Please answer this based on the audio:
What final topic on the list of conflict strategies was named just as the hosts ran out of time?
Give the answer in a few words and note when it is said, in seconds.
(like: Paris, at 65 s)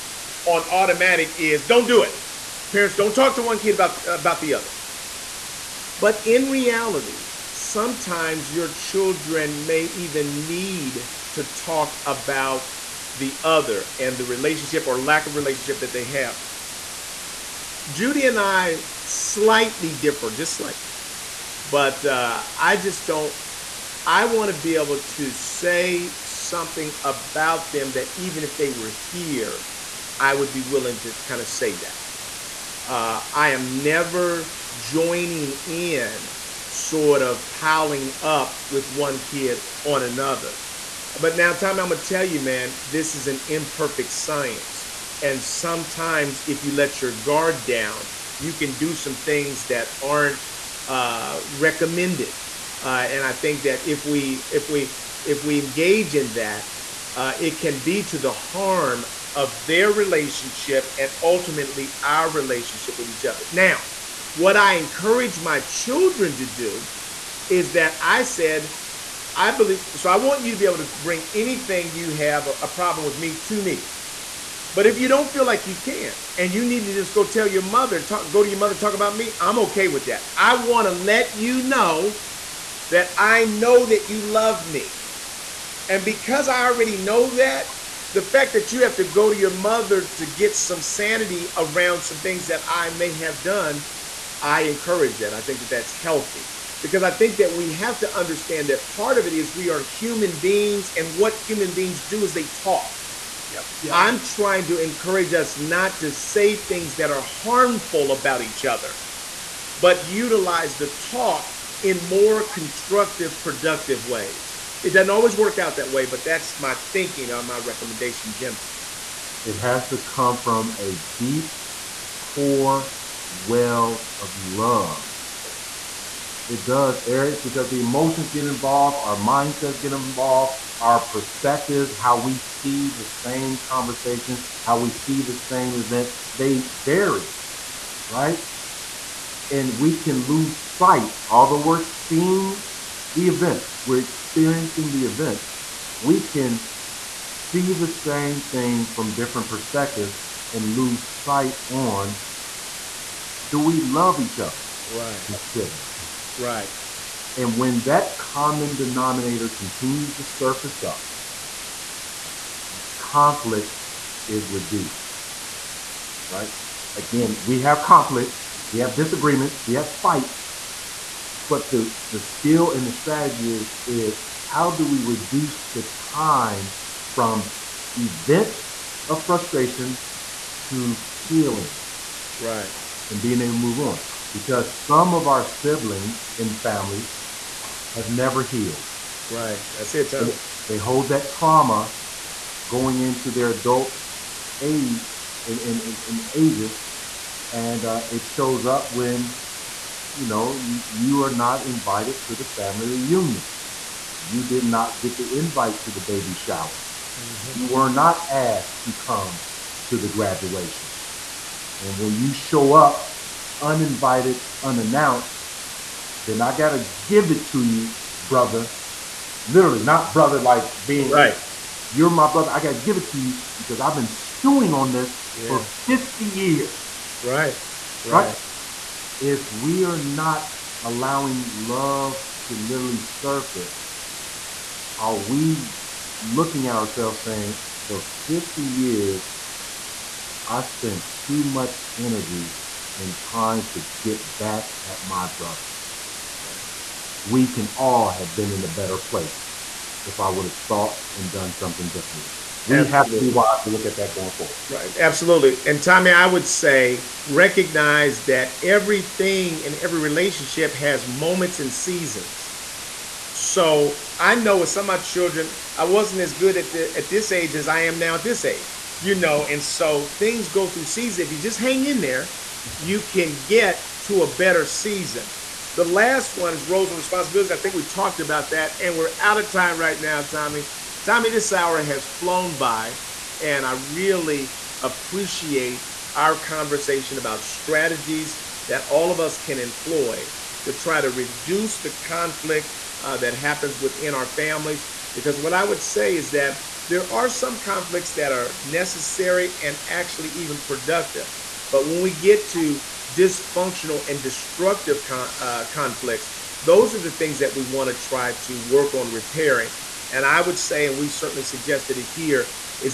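Roles and responsibilities, at 276 s.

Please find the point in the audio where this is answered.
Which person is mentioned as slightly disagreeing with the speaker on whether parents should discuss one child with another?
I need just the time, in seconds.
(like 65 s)
17 s.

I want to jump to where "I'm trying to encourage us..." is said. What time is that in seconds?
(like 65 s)
103 s.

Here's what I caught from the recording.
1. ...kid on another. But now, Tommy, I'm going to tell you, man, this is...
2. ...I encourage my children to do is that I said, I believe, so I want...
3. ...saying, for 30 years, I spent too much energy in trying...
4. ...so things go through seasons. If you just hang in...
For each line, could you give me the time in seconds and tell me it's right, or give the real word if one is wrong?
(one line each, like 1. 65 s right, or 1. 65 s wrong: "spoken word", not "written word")
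1. 39 s right
2. 64 s right
3. 237 s wrong: "50", not "30"
4. 269 s right.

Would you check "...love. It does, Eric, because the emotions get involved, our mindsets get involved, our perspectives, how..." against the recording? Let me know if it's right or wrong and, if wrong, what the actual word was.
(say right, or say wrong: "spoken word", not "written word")
right.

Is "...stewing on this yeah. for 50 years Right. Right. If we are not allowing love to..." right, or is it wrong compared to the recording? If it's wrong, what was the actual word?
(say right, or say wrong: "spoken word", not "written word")
right.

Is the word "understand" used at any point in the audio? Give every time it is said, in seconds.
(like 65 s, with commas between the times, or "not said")
98 s.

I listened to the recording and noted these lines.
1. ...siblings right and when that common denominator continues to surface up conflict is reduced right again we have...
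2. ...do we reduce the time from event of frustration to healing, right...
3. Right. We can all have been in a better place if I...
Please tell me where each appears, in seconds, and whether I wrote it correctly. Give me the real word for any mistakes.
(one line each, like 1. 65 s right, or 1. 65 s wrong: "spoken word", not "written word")
1. 155 s right
2. 174 s right
3. 246 s right.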